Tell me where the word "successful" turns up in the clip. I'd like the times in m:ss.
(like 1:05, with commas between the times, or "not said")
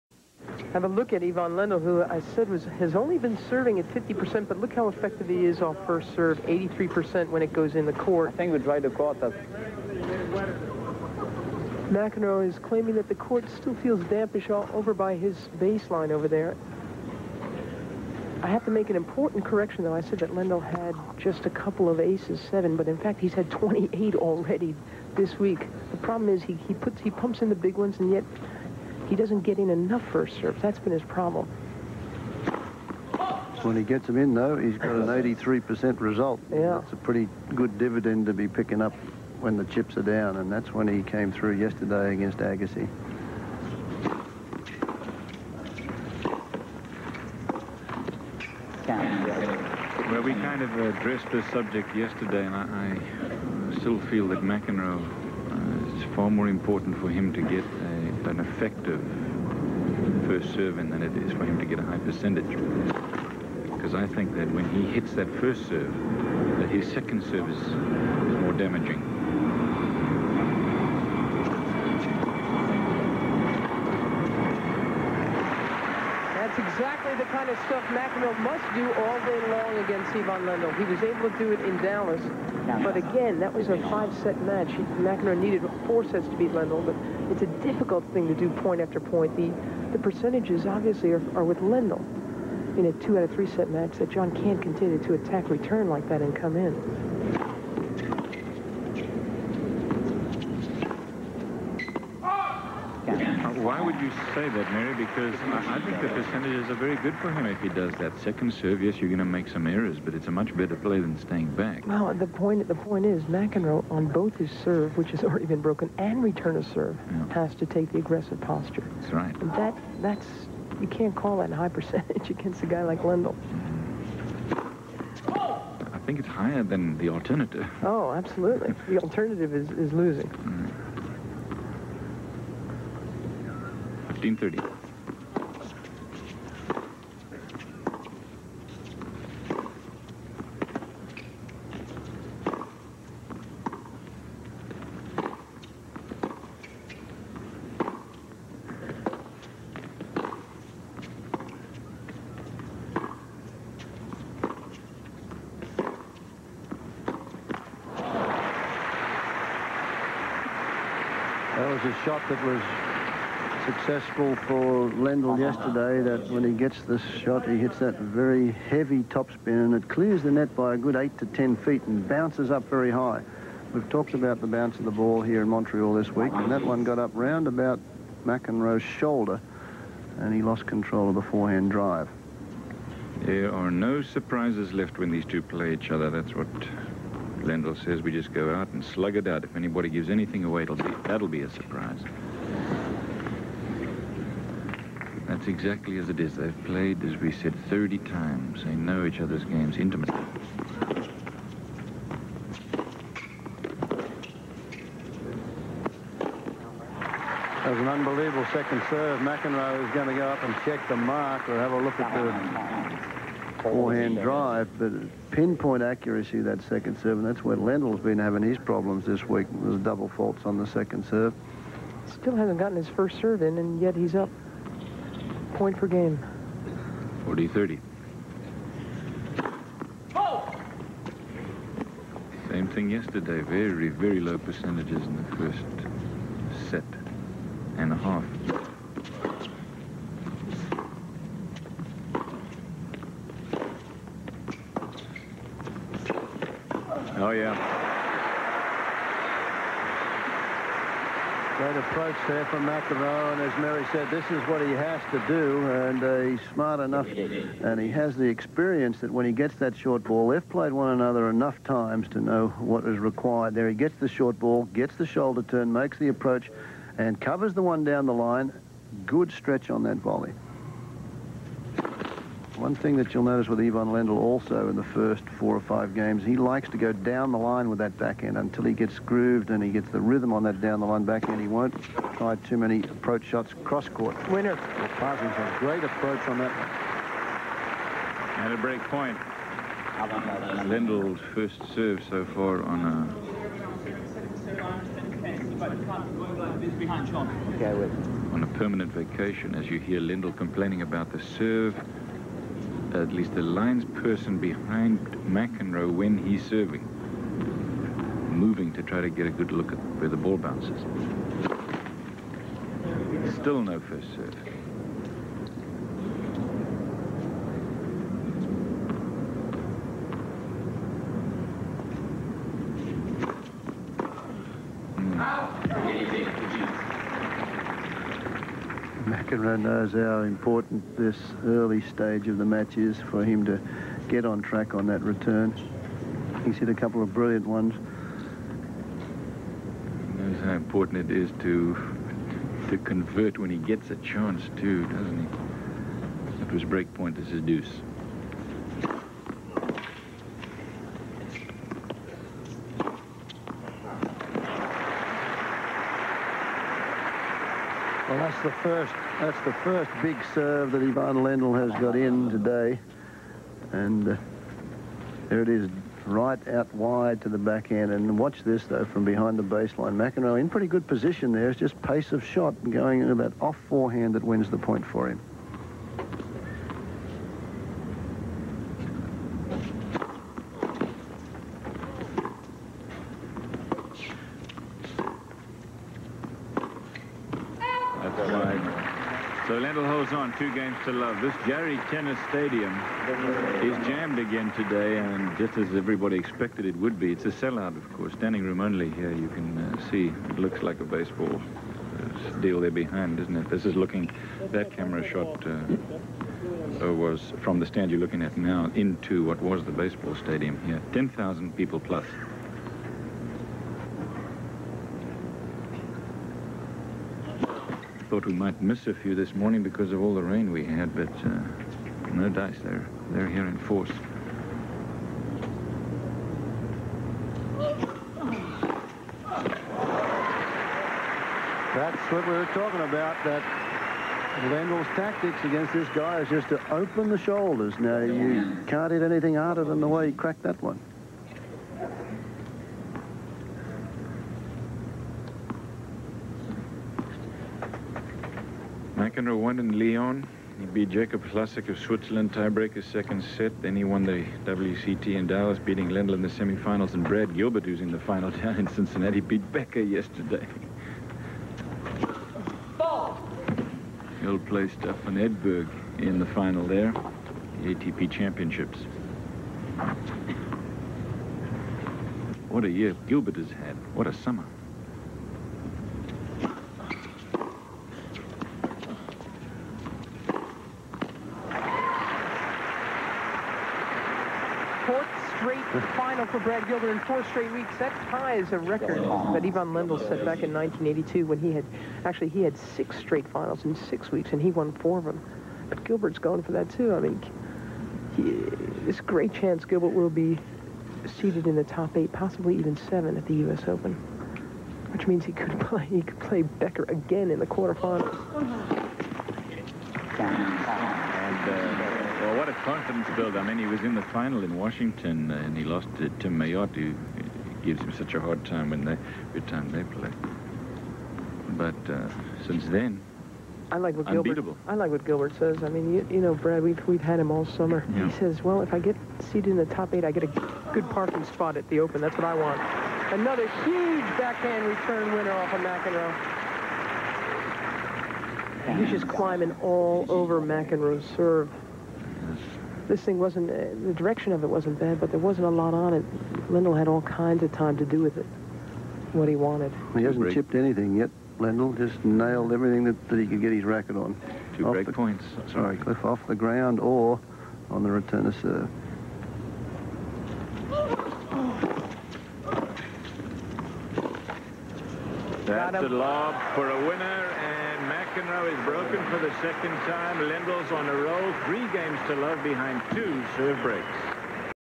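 2:43.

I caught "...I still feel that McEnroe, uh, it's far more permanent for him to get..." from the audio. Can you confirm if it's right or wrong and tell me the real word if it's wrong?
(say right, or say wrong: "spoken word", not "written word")
wrong: "important", not "permanent".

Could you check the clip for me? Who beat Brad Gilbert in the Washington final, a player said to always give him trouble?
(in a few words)
Tim Mayotte.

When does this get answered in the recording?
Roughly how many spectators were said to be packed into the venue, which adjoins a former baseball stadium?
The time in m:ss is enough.
6:50.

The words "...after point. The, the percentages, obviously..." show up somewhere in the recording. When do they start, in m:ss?
1:28.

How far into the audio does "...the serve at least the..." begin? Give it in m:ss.
5:01.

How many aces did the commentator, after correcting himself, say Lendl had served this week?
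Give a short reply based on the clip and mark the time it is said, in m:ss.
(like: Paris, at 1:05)
28, at 0:23.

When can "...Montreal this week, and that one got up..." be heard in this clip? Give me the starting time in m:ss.
2:55.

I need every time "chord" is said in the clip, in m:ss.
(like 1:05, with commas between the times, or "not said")
not said.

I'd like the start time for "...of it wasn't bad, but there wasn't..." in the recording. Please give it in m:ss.
9:04.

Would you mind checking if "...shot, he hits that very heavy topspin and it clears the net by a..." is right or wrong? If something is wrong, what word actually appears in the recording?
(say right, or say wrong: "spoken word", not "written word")
right.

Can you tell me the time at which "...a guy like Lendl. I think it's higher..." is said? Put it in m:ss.
2:02.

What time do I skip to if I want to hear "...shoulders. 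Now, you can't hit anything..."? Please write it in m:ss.
7:17.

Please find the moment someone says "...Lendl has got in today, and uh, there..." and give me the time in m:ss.
6:01.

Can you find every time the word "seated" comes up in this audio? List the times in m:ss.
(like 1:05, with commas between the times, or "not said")
8:21, 8:49.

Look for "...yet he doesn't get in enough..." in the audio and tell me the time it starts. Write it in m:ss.
0:28.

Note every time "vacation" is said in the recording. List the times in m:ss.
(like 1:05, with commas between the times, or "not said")
4:58.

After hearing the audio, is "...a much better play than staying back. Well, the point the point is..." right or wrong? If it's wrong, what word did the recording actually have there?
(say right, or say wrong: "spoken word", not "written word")
right.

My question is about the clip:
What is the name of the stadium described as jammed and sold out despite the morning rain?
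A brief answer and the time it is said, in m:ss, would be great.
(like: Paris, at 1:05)
Jarry Tennis Stadium, at 6:31.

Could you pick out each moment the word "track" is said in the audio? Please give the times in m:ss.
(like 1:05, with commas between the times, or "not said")
5:34.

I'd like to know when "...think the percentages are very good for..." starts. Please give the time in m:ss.
1:45.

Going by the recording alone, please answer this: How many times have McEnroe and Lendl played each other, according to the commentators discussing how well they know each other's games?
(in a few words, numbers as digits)
30.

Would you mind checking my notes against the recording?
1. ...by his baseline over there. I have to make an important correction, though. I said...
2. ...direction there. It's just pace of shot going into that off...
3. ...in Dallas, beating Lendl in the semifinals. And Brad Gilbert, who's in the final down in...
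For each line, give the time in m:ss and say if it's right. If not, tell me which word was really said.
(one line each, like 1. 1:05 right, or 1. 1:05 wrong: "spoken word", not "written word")
1. 0:14 right
2. 6:10 wrong: "position", not "direction"
3. 7:35 right.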